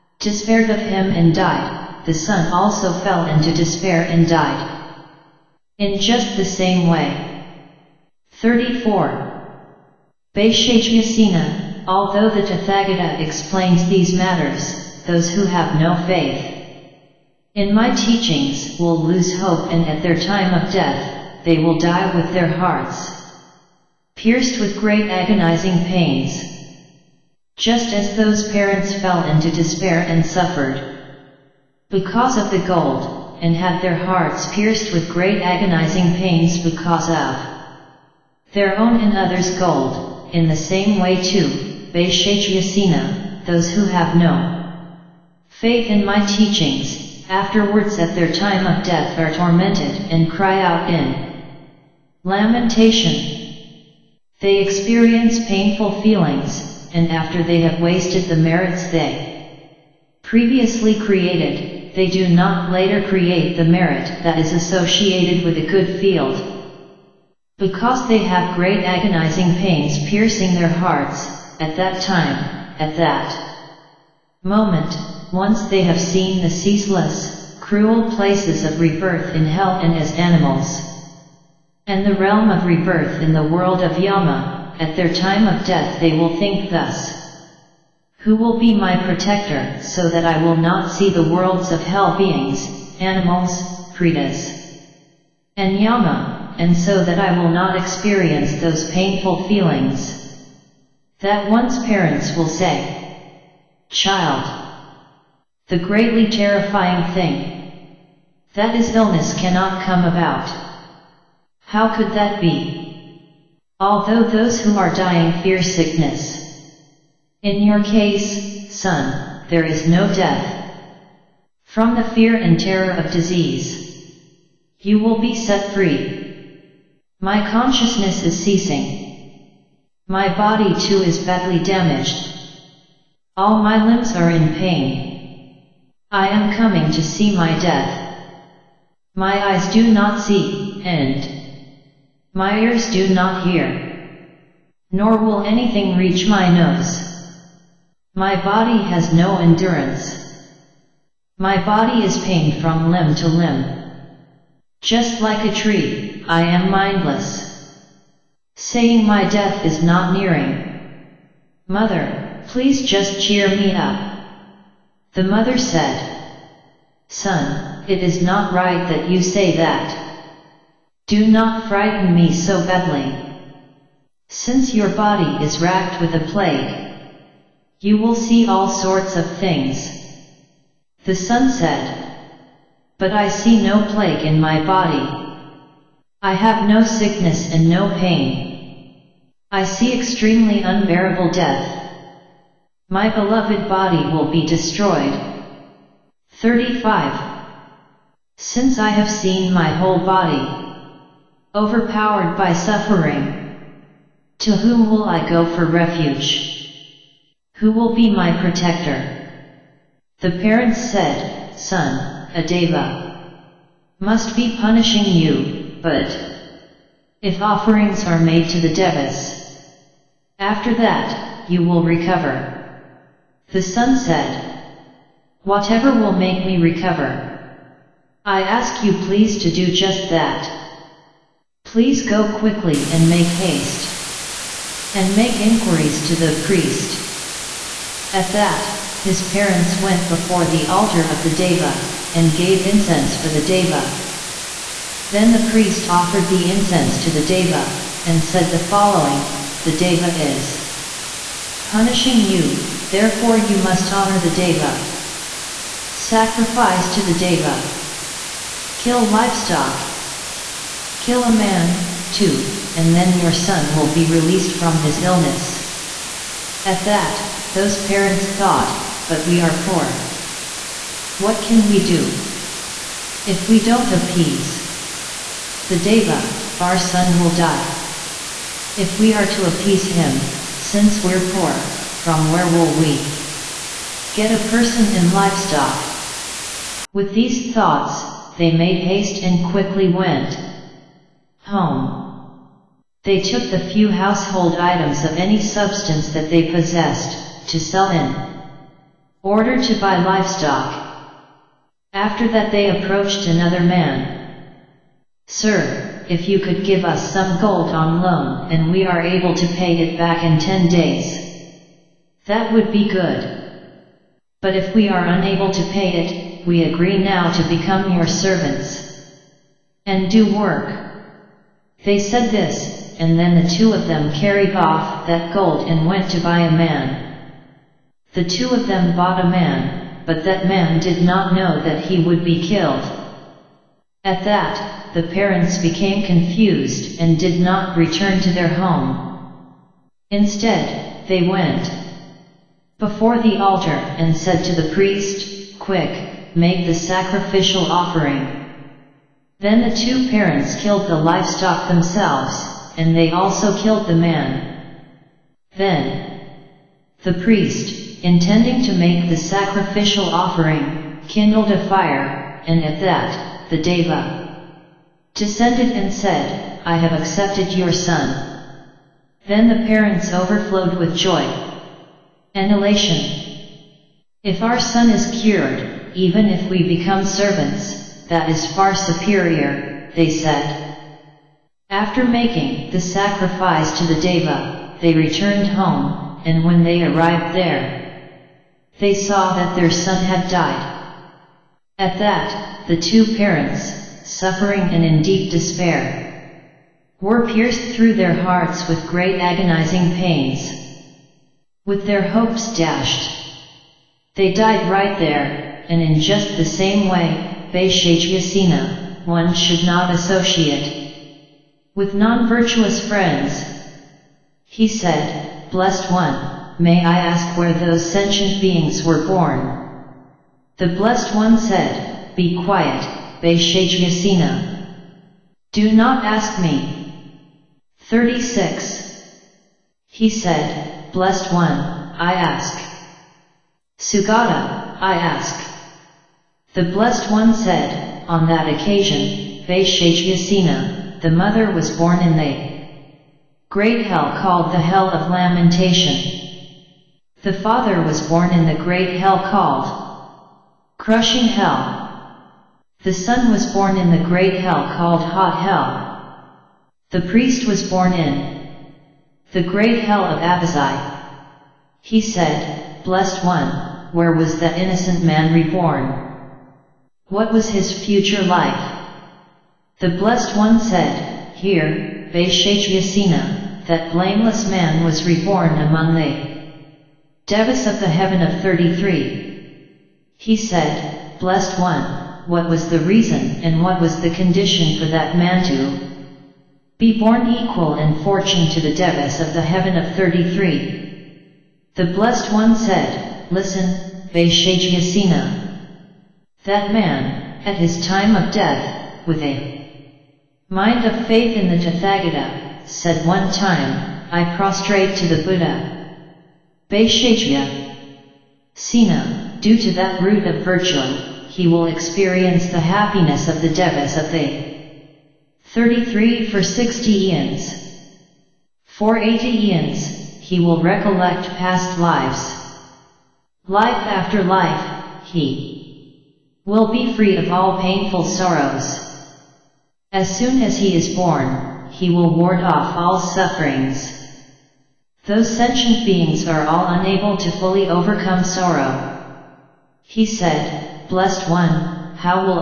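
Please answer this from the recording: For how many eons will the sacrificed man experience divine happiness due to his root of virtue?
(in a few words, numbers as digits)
60.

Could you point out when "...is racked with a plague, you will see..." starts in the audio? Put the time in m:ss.
2:55.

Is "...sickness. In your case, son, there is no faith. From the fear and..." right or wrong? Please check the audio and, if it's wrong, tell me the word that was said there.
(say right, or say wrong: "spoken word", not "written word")
wrong: "death", not "faith".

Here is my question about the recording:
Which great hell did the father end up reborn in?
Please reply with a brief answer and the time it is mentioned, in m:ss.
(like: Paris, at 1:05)
Crushing Hell, at 7:30.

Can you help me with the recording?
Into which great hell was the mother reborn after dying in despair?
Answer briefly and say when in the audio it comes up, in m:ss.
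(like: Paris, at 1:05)
Hell of Lamentation, at 7:24.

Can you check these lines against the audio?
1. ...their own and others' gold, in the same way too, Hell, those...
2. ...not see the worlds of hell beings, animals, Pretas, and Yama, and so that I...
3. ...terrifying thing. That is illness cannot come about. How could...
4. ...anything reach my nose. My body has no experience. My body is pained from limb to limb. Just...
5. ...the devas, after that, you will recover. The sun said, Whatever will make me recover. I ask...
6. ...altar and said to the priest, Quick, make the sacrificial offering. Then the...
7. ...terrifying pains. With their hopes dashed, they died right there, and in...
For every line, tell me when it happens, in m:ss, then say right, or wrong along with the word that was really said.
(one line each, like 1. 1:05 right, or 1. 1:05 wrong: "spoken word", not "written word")
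1. 0:38 wrong: "Bhaishajyasena", not "Hell"
2. 1:30 right
3. 1:46 right
4. 2:25 wrong: "endurance", not "experience"
5. 3:38 right
6. 5:43 right
7. 6:39 wrong: "agonizing", not "terrifying".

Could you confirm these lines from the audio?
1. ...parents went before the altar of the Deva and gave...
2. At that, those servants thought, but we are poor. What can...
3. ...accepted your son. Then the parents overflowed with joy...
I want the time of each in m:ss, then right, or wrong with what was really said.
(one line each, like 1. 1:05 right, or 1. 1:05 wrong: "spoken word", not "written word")
1. 3:59 right
2. 4:26 wrong: "parents", not "servants"
3. 6:06 right.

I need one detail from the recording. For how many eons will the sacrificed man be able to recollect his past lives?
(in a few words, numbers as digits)
80.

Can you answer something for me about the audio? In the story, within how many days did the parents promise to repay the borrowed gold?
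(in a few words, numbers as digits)
10.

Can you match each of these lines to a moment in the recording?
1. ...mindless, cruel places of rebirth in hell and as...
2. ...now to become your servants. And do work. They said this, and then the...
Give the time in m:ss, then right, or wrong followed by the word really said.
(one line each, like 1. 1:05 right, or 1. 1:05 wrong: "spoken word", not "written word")
1. 1:16 wrong: "ceaseless", not "mindless"
2. 5:17 right.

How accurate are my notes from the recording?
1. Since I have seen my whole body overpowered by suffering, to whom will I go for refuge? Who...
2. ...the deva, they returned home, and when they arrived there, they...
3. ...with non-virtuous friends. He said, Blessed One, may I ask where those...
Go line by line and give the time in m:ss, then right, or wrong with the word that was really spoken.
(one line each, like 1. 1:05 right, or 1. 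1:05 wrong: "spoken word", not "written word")
1. 3:18 right
2. 6:23 right
3. 6:51 right.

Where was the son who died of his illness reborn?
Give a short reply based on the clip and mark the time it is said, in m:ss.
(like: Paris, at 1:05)
Hot Hell, at 7:34.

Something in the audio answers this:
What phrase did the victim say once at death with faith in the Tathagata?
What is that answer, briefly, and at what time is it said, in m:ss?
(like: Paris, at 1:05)
I prostrate to the Buddha, at 8:24.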